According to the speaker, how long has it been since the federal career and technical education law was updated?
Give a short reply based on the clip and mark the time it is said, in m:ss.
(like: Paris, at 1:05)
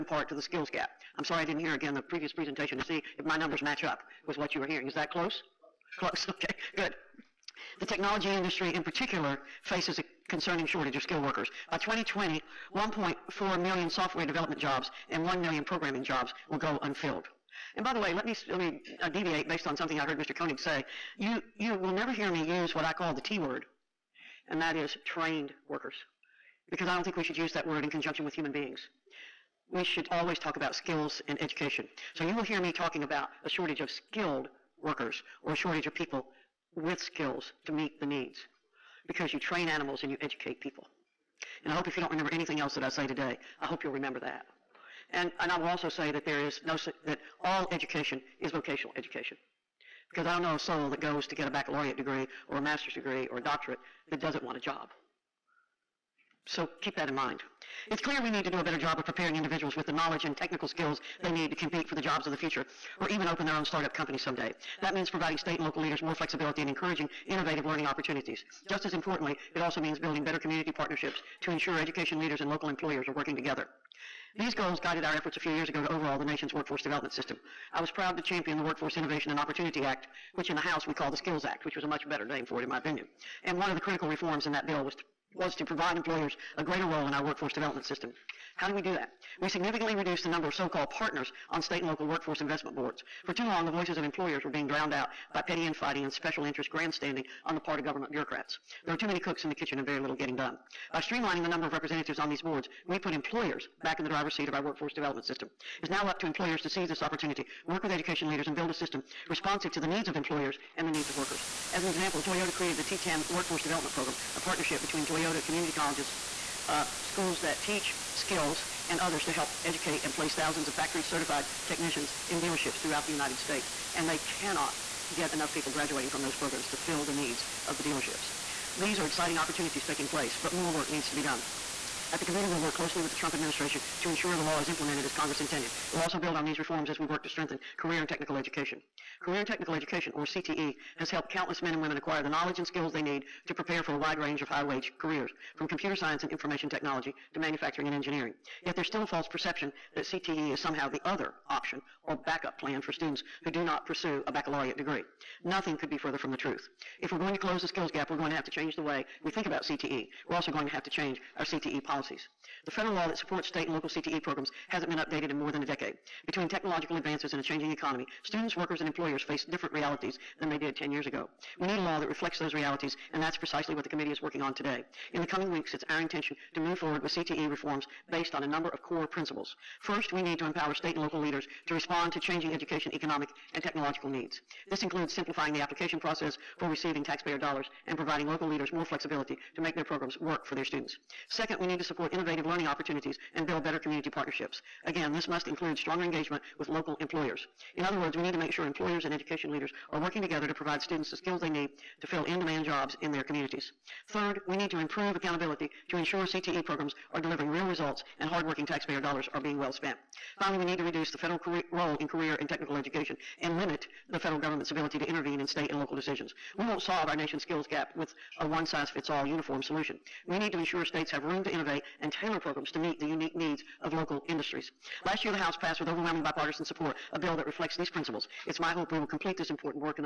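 more than a decade, at 2:45.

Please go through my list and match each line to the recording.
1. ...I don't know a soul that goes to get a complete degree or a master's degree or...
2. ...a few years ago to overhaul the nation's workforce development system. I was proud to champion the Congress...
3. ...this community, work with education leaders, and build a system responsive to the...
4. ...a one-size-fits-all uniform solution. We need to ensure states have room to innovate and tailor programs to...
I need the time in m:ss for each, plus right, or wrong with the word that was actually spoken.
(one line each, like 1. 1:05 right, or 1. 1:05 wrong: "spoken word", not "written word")
1. 0:50 wrong: "baccalaureate", not "complete"
2. 1:15 wrong: "Workforce", not "Congress"
3. 1:46 wrong: "opportunity", not "community"
4. 3:38 right.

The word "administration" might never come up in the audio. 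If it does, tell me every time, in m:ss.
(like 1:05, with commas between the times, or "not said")
2:13.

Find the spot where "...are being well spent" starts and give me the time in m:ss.
3:29.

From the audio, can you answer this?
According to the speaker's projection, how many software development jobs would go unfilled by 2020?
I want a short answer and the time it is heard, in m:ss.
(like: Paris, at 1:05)
1.4 million, at 0:12.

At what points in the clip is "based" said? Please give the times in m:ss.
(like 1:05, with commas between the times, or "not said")
0:19, 2:58.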